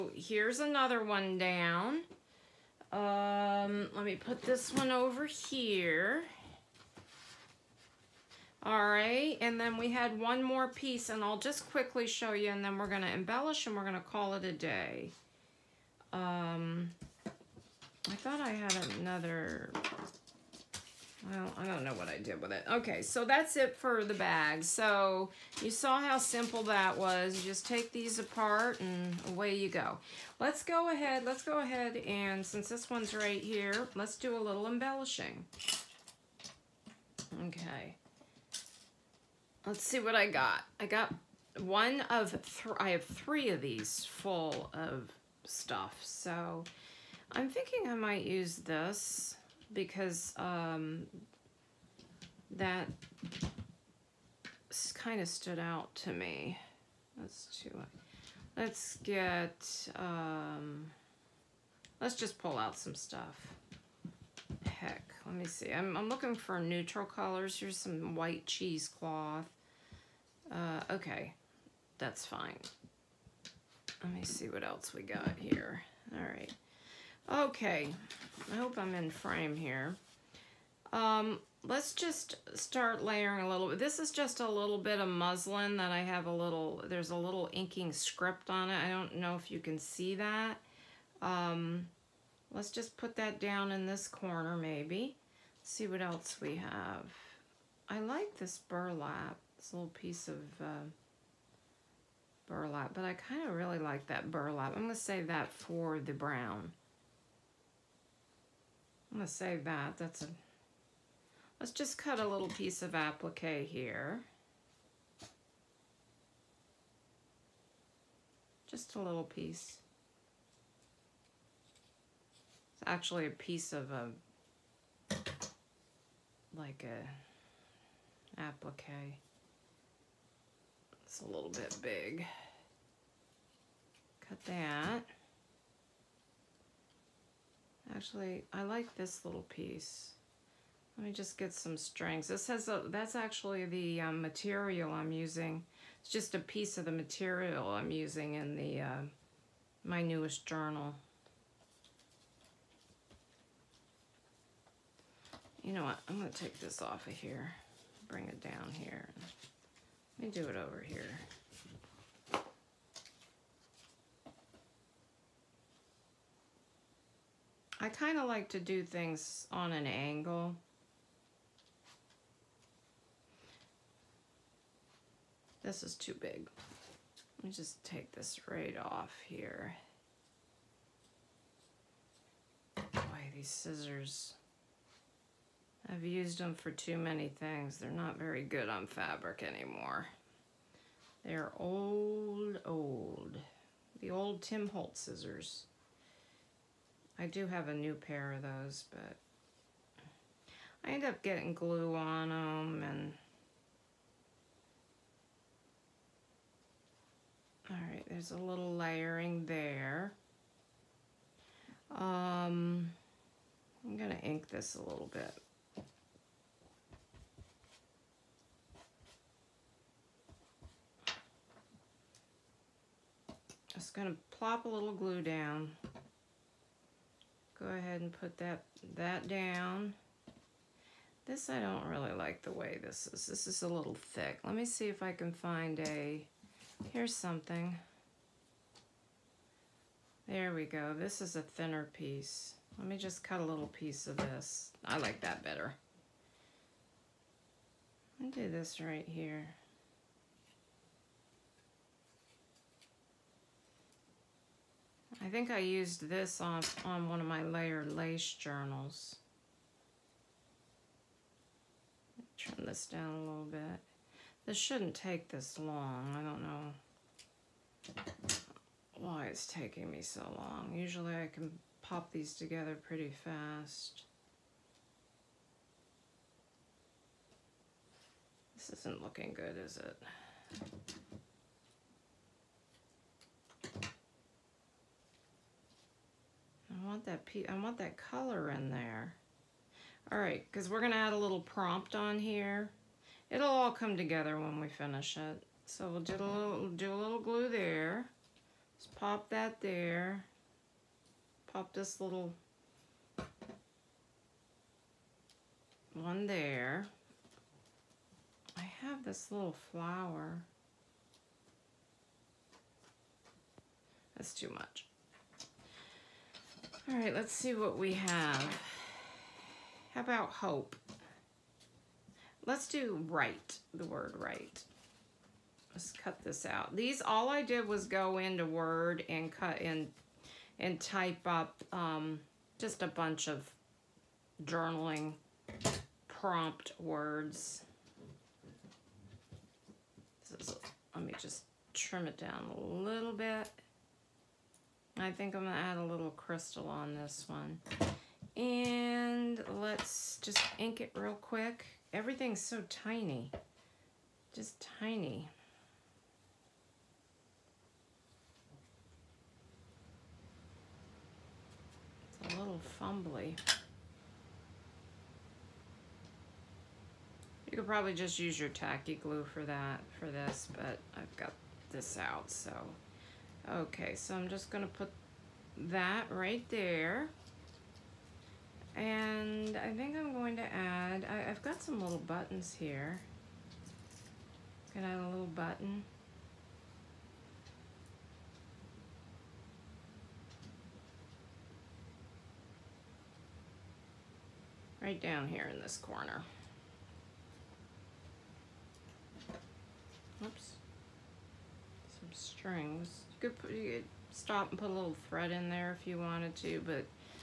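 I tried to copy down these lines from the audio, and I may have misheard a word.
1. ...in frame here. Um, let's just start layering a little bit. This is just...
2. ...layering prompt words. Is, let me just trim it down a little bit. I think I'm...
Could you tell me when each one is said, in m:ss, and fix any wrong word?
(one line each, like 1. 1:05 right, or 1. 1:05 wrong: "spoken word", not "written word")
1. 1:18 right
2. 5:34 wrong: "journaling", not "layering".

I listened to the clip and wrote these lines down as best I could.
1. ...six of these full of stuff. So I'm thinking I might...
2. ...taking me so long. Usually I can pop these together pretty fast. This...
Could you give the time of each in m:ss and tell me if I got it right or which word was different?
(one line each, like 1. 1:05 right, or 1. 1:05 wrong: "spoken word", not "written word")
1. 0:43 wrong: "three", not "six"
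2. 4:29 right.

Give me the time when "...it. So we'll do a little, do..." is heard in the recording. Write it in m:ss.
4:55.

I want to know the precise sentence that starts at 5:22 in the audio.
Let's do right, the word right.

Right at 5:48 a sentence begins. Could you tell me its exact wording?
And let's just ink it real quick.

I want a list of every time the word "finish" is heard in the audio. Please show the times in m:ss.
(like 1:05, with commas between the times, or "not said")
4:54.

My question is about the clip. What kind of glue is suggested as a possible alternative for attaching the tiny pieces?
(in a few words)
Tacky glue.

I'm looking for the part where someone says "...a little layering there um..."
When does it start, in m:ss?
3:28.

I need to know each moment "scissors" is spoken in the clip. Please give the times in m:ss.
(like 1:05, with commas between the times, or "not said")
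3:03, 3:15.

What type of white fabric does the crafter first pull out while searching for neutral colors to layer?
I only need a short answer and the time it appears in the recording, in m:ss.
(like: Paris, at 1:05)
Cheesecloth, at 1:08.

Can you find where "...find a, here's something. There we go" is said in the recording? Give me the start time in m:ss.
3:55.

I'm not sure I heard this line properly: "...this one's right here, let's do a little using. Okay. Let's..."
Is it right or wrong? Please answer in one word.
wrong.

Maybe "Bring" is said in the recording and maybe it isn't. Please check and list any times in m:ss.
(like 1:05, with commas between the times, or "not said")
2:38.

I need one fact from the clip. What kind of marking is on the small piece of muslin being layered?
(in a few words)
Inking script.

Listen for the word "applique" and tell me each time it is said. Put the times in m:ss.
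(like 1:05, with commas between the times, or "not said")
1:52, 2:08.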